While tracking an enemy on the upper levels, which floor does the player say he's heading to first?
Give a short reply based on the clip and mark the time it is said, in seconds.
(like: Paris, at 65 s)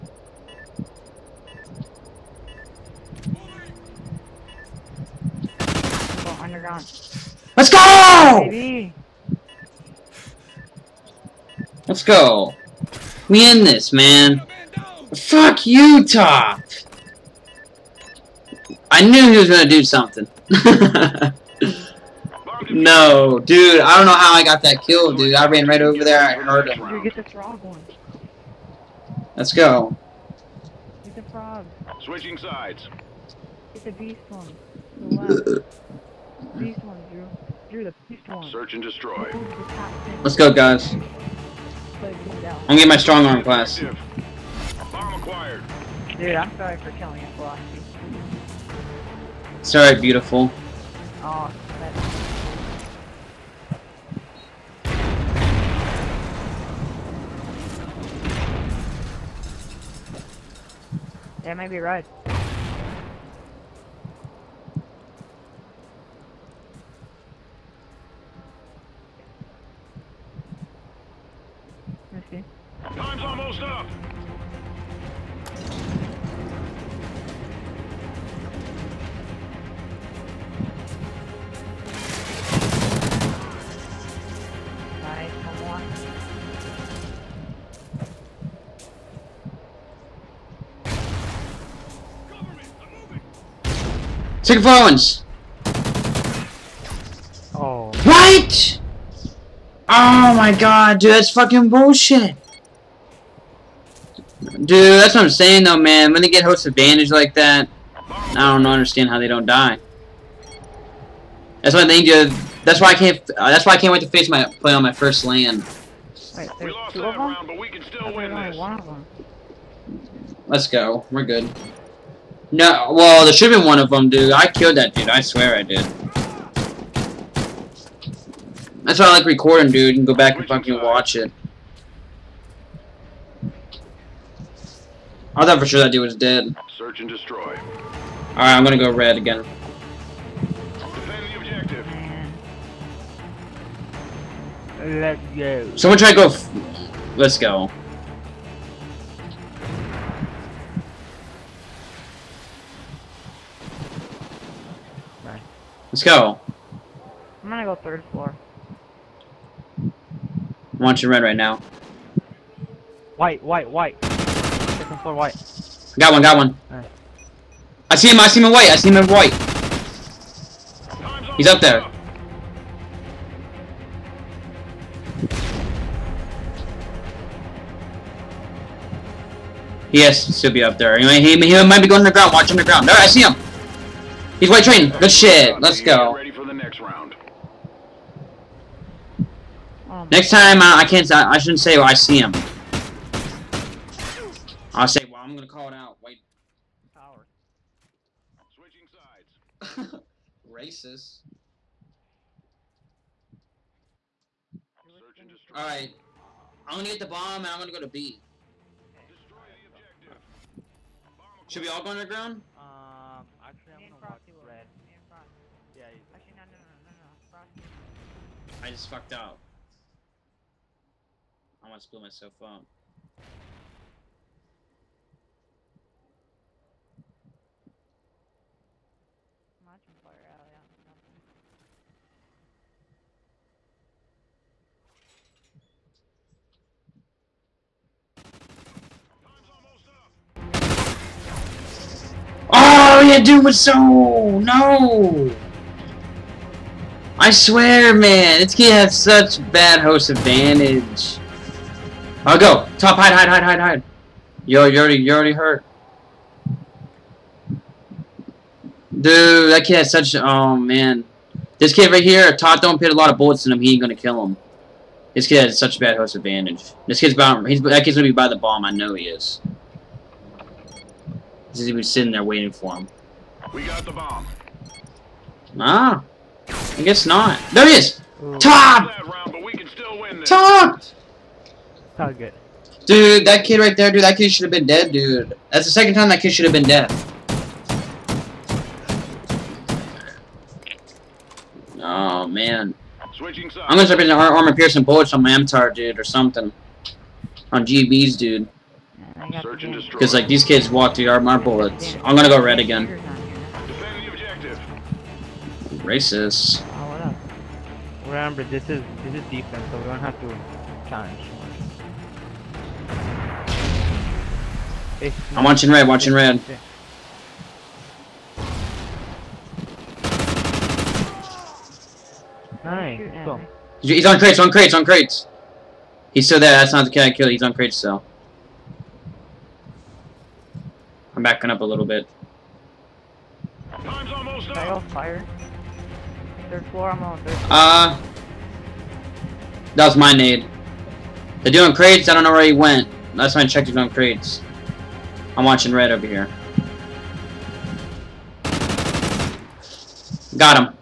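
third floor, at 157 s.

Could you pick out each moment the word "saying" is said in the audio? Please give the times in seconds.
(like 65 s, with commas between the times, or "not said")
105 s.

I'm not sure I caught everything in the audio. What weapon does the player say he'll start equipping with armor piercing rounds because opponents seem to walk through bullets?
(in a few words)
MTAR.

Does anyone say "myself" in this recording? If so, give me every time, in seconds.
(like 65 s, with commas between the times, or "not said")
222 s.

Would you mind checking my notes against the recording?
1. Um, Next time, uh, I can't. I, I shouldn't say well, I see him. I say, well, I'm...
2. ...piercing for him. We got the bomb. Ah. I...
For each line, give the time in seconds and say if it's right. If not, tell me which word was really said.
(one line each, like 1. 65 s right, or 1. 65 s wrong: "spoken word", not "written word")
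1. 189 s right
2. 272 s wrong: "waiting", not "piercing".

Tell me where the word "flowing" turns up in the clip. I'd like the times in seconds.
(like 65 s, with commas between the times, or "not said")
not said.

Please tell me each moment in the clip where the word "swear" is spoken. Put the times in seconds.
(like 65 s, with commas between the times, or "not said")
125 s, 247 s.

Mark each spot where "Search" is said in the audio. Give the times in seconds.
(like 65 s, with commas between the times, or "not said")
38 s, 136 s.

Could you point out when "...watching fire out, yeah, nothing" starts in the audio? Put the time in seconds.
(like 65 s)
229 s.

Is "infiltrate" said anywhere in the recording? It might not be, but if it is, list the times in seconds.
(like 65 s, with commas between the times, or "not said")
not said.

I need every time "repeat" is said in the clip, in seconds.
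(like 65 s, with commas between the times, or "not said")
not said.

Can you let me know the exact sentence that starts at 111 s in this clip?
That's why they need That's why I can't.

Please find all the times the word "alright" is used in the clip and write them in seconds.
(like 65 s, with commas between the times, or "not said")
49 s, 137 s, 204 s.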